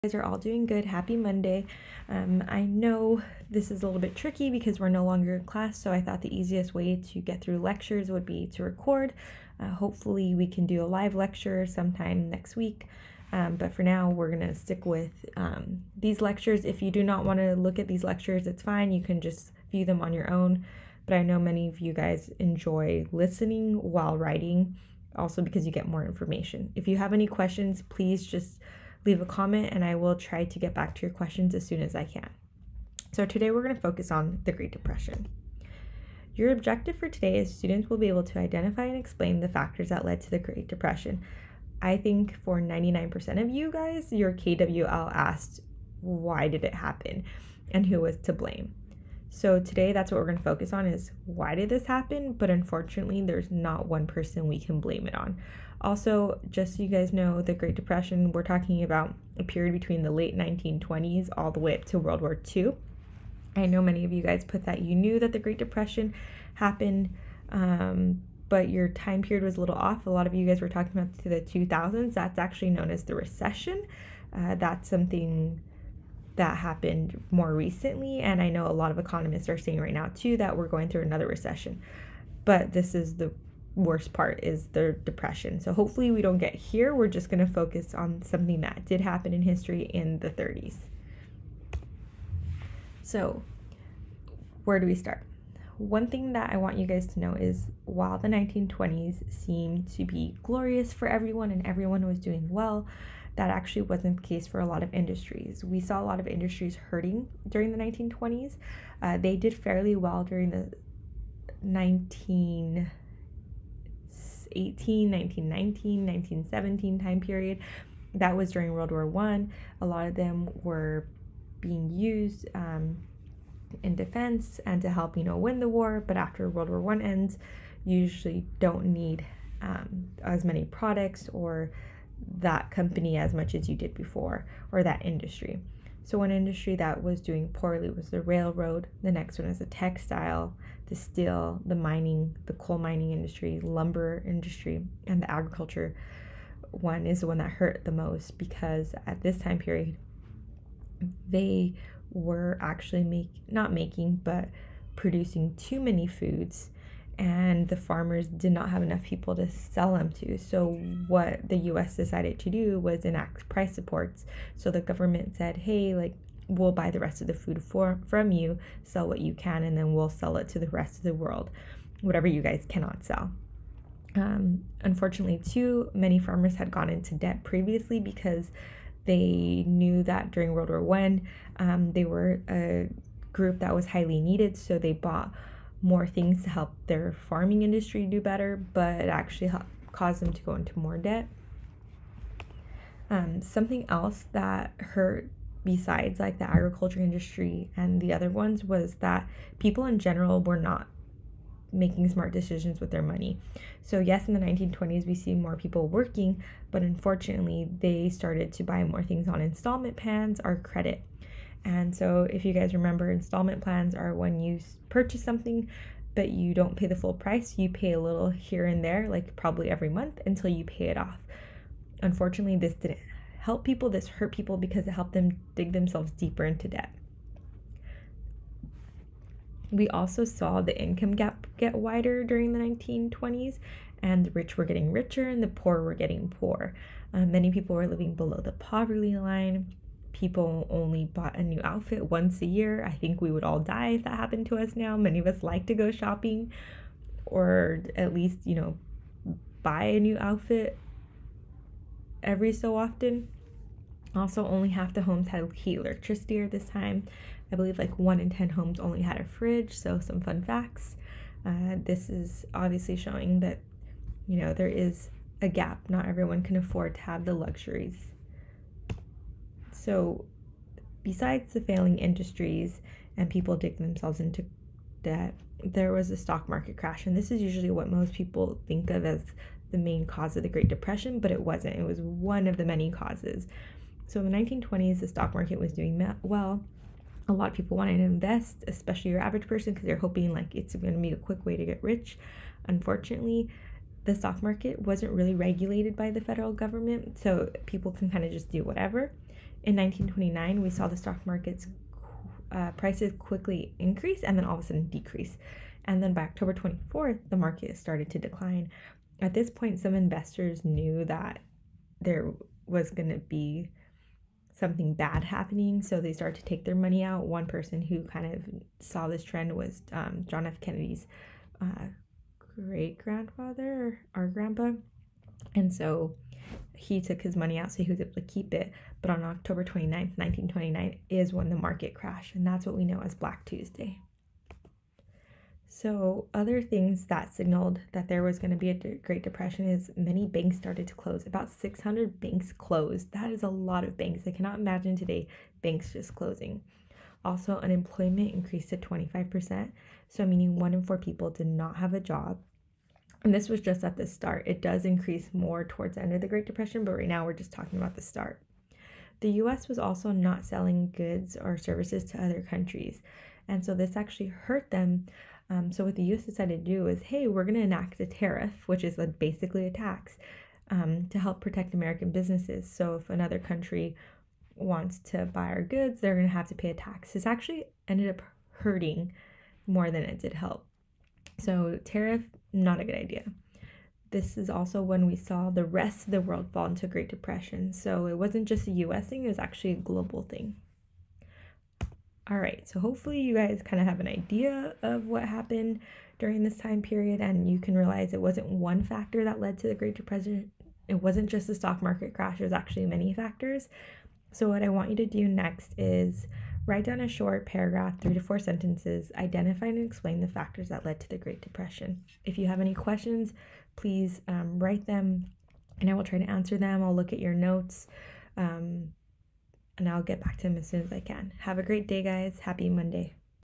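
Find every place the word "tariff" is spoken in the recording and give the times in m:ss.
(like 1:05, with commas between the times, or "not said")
6:08, 6:21.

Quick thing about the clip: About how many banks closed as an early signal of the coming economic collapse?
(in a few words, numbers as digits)
600.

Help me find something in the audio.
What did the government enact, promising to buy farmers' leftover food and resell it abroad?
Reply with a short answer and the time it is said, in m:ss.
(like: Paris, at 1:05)
price supports, at 2:43.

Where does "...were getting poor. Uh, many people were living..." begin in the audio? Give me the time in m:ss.
3:55.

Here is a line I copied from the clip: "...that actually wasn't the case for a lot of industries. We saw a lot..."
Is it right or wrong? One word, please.
right.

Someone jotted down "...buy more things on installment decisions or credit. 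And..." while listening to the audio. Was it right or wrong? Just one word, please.
wrong.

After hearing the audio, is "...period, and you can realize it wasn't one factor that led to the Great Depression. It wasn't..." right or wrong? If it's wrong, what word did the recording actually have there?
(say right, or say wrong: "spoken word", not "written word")
right.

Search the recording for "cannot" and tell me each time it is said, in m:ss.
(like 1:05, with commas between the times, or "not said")
2:52, 5:44.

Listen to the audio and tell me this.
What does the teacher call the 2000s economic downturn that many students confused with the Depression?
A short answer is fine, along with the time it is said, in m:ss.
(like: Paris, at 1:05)
the recession, at 1:13.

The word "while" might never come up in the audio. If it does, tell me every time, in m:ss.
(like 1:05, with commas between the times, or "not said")
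0:23, 1:37.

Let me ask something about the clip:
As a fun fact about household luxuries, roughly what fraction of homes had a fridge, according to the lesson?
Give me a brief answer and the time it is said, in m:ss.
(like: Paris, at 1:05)
1 in 10, at 4:17.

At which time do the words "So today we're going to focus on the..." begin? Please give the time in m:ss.
0:33.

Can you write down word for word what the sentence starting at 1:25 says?
So hopefully we don't get here.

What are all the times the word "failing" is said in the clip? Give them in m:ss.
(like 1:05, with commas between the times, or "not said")
4:31.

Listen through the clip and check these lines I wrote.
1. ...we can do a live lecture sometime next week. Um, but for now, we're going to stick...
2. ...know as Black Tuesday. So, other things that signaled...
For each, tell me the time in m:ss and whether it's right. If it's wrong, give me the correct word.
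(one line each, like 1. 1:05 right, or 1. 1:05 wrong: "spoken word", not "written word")
1. 0:10 right
2. 5:32 right.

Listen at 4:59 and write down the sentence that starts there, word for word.
In 1929, we saw the stock market's uh, prices quickly increase and then all of a sudden decrease.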